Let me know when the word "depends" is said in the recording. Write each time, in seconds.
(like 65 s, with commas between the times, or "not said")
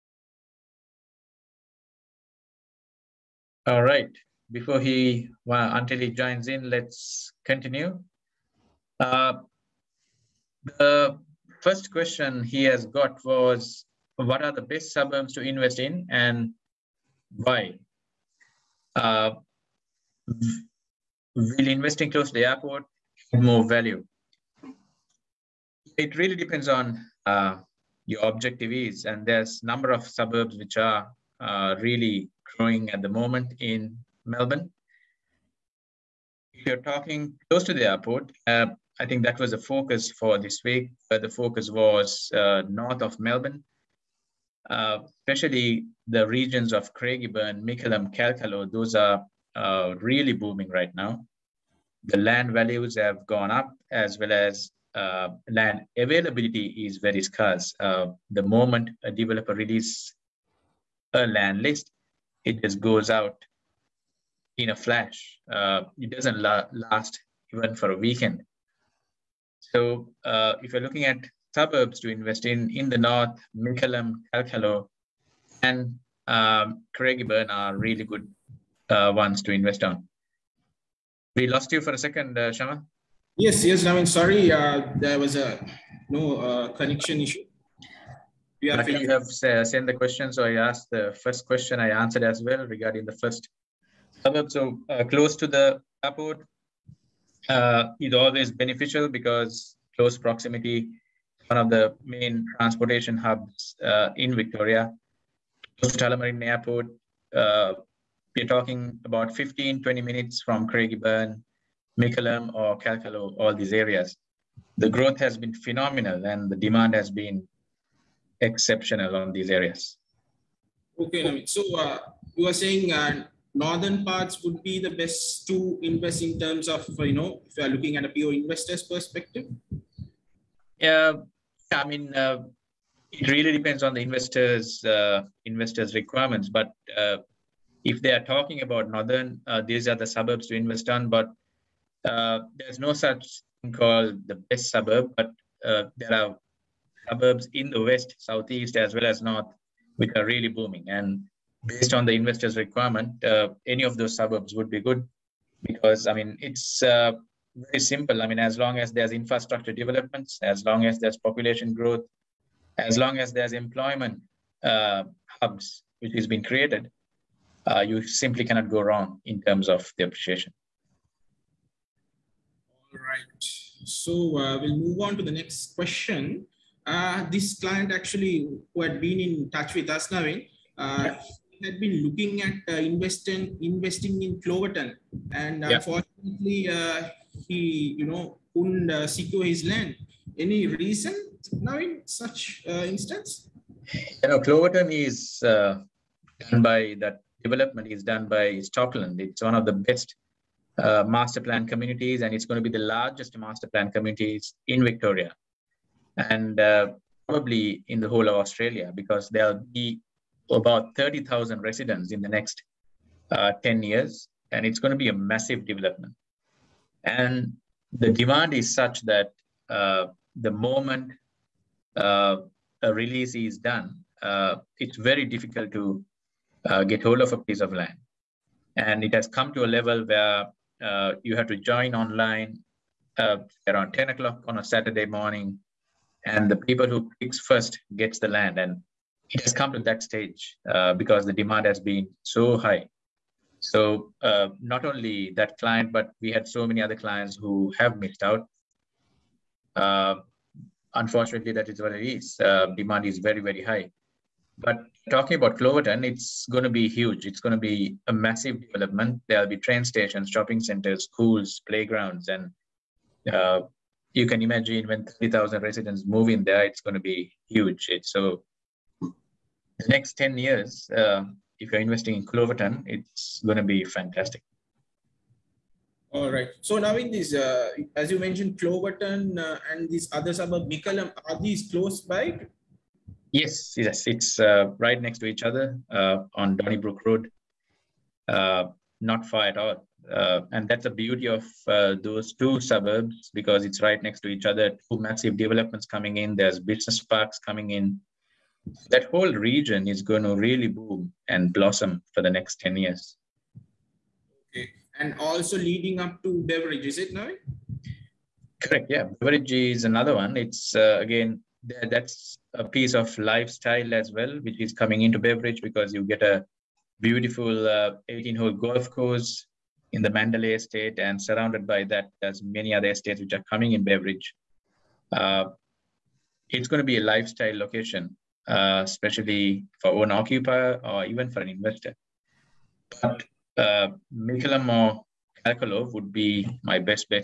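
26 s, 133 s.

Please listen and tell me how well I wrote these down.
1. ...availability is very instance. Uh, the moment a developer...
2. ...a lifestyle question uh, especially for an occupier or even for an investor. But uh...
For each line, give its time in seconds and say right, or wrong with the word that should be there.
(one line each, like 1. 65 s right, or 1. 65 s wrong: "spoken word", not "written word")
1. 55 s wrong: "scarce", not "instance"
2. 326 s wrong: "location", not "question".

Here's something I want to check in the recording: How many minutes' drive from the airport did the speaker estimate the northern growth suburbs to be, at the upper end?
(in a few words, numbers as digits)
20 minutes.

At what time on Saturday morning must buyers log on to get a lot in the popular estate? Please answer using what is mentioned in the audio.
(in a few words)
10 o'clock.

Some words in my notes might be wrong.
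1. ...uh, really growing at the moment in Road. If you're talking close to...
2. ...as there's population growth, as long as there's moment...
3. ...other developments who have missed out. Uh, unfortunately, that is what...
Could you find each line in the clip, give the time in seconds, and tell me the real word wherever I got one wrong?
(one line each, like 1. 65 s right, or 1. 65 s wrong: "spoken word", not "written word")
1. 31 s wrong: "Melbourne", not "Road"
2. 160 s wrong: "employment", not "moment"
3. 246 s wrong: "clients", not "developments".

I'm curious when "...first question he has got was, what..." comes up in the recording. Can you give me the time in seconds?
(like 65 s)
11 s.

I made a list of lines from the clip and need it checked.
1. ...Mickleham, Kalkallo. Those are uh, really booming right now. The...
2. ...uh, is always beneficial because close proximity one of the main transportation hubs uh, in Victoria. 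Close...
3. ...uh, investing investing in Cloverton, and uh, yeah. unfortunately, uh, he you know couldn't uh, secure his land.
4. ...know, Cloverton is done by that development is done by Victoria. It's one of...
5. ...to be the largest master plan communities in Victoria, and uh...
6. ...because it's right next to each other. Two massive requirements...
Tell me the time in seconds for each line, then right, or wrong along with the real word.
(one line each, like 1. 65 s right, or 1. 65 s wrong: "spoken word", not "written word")
1. 47 s right
2. 97 s right
3. 182 s right
4. 194 s wrong: "Stockland", not "Victoria"
5. 202 s right
6. 293 s wrong: "developments", not "requirements".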